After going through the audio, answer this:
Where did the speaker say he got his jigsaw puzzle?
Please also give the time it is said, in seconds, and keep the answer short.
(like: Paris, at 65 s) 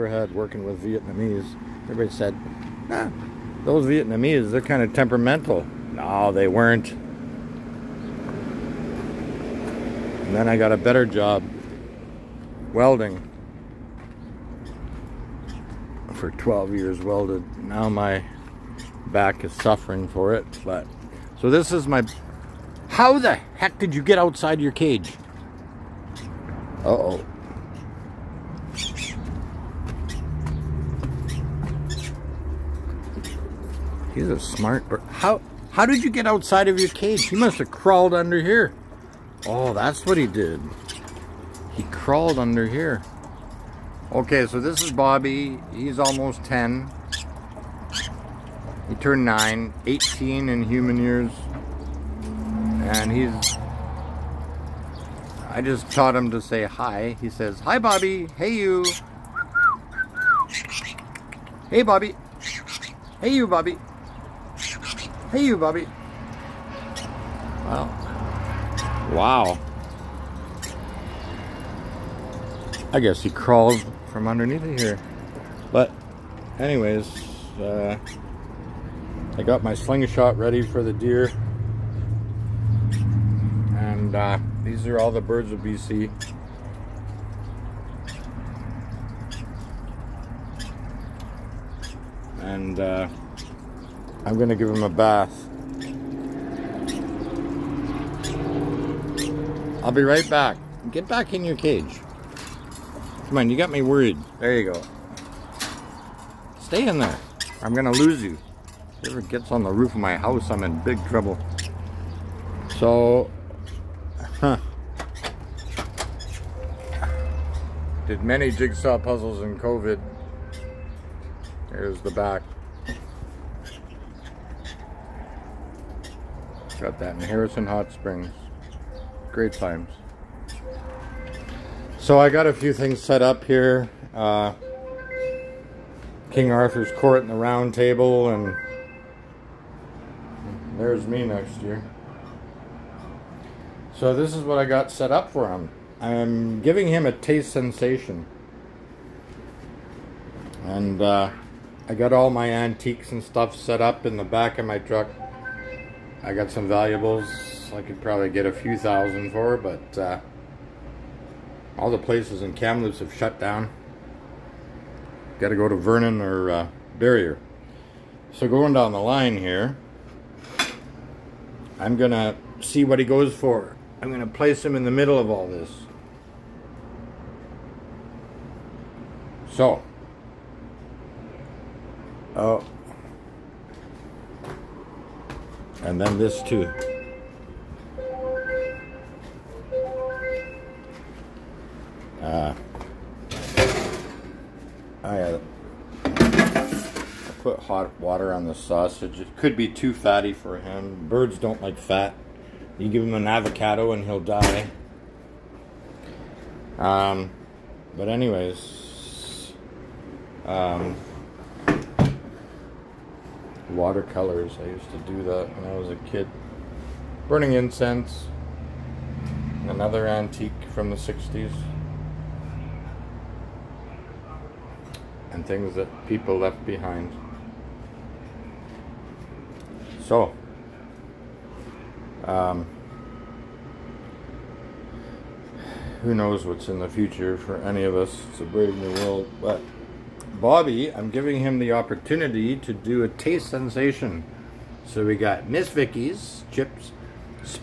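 Harrison Hot Springs, at 127 s.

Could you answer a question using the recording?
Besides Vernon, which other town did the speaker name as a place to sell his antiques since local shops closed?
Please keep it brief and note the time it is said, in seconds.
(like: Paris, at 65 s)
Barriere, at 166 s.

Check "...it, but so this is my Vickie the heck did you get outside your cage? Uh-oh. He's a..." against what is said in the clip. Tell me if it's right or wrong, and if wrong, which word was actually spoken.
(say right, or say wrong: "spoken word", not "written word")
wrong: "How", not "Vickie".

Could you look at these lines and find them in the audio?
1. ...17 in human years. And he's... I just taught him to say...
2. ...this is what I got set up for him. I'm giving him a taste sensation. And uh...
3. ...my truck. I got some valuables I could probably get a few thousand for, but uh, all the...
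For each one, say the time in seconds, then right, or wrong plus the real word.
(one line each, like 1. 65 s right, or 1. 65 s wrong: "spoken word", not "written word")
1. 49 s wrong: "18", not "17"
2. 144 s right
3. 154 s right.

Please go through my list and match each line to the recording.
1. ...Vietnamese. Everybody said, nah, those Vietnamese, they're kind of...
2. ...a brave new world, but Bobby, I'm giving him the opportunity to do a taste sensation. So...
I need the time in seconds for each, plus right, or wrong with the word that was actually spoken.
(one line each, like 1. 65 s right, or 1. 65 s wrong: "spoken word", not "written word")
1. 0 s right
2. 238 s right.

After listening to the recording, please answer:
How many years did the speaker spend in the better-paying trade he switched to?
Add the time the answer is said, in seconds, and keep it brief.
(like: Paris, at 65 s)
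12, at 16 s.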